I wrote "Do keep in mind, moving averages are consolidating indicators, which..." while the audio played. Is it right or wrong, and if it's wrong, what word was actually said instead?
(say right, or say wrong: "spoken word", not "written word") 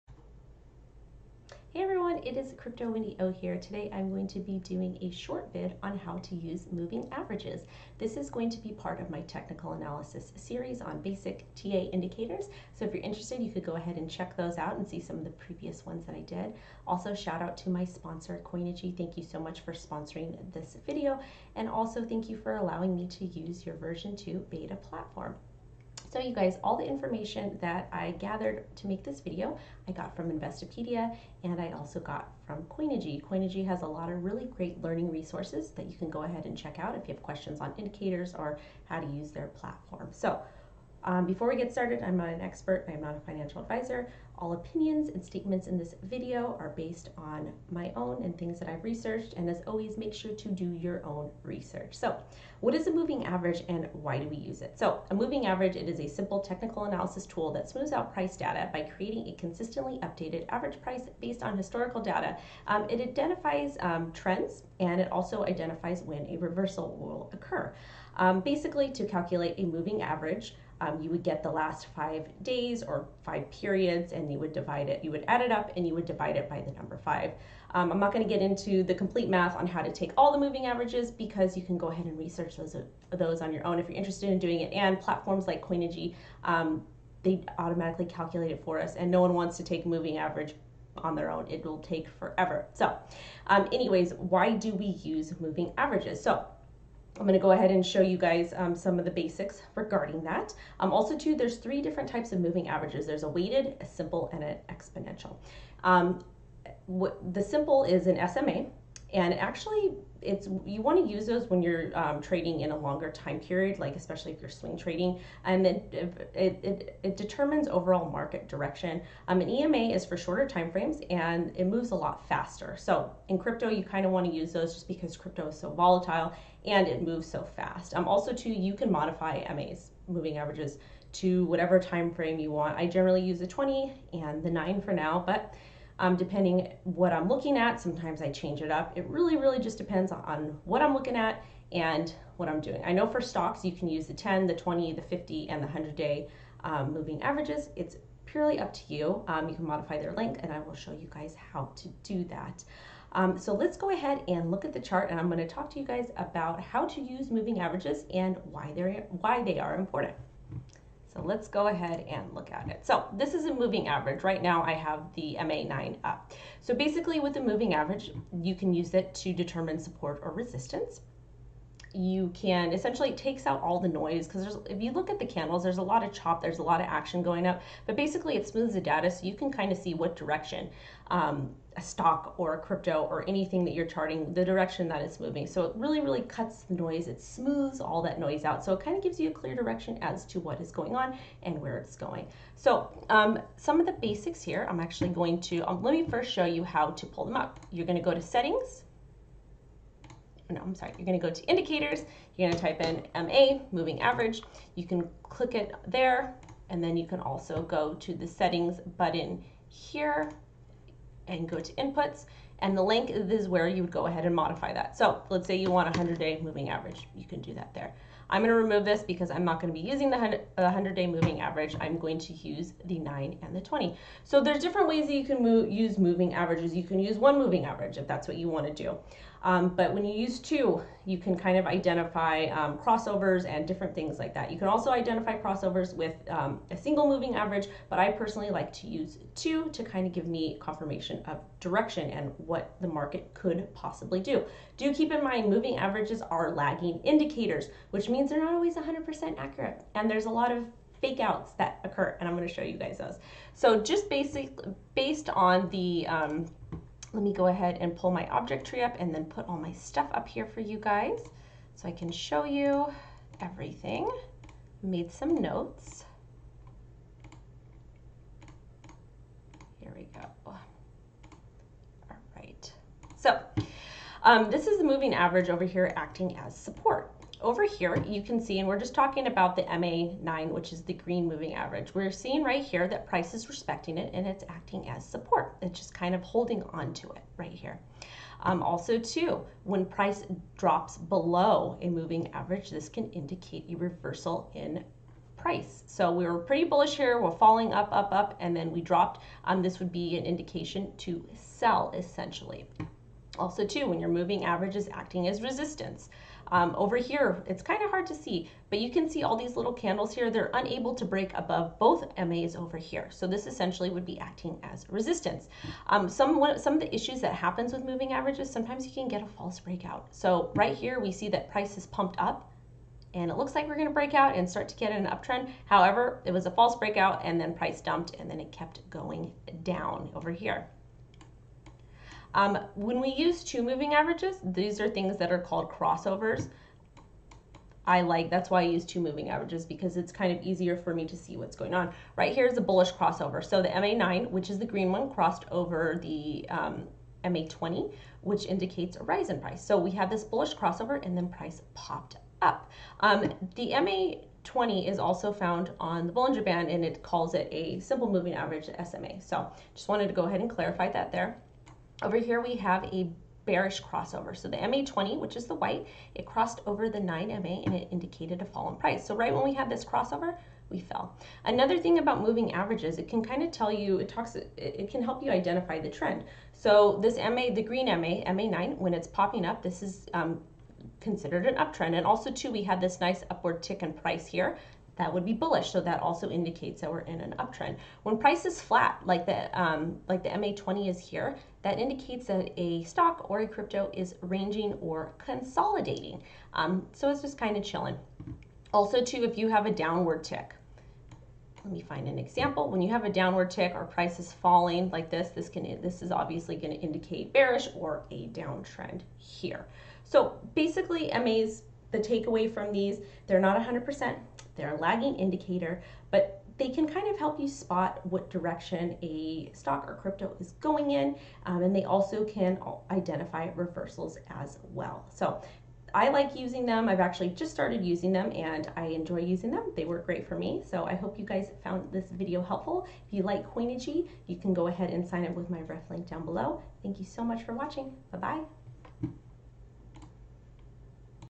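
wrong: "lagging", not "consolidating".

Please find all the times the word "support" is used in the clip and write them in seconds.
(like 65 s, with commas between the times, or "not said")
169 s, 276 s, 285 s.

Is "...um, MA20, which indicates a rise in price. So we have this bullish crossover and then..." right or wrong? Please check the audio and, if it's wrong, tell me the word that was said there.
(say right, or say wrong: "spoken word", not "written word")
right.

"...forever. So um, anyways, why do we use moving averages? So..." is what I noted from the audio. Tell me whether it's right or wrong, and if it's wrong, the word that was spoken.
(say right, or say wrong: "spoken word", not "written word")
right.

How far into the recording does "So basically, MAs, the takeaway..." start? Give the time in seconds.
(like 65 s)
410 s.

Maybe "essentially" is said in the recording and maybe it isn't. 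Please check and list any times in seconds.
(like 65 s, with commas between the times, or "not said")
172 s, 301 s, 313 s.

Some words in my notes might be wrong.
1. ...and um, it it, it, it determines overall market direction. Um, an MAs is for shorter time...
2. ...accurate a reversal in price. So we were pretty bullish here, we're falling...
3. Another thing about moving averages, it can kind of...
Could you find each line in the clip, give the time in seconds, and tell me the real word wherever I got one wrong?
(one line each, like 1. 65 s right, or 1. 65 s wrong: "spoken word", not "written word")
1. 115 s wrong: "EMA", not "MAs"
2. 293 s wrong: "indicate", not "accurate"
3. 371 s right.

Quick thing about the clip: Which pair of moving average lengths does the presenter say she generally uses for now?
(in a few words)
20 and 9.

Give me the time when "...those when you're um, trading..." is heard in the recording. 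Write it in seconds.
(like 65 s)
111 s.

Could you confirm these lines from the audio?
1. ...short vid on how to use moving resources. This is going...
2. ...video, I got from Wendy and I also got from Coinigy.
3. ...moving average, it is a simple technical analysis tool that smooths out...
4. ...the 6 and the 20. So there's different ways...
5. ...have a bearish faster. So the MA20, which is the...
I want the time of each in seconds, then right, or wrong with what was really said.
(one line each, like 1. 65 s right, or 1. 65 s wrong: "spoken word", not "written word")
1. 5 s wrong: "averages", not "resources"
2. 29 s wrong: "Investopedia", not "Wendy"
3. 55 s right
4. 222 s wrong: "9", not "6"
5. 362 s wrong: "crossover", not "faster".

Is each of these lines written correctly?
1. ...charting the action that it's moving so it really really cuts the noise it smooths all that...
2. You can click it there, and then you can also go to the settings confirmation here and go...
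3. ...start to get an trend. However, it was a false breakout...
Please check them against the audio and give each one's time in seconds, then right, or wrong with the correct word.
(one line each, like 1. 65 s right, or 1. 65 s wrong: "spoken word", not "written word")
1. 183 s wrong: "direction", not "action"
2. 204 s wrong: "button", not "confirmation"
3. 324 s wrong: "uptrend", not "trend".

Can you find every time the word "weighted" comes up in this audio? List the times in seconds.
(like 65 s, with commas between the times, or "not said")
103 s.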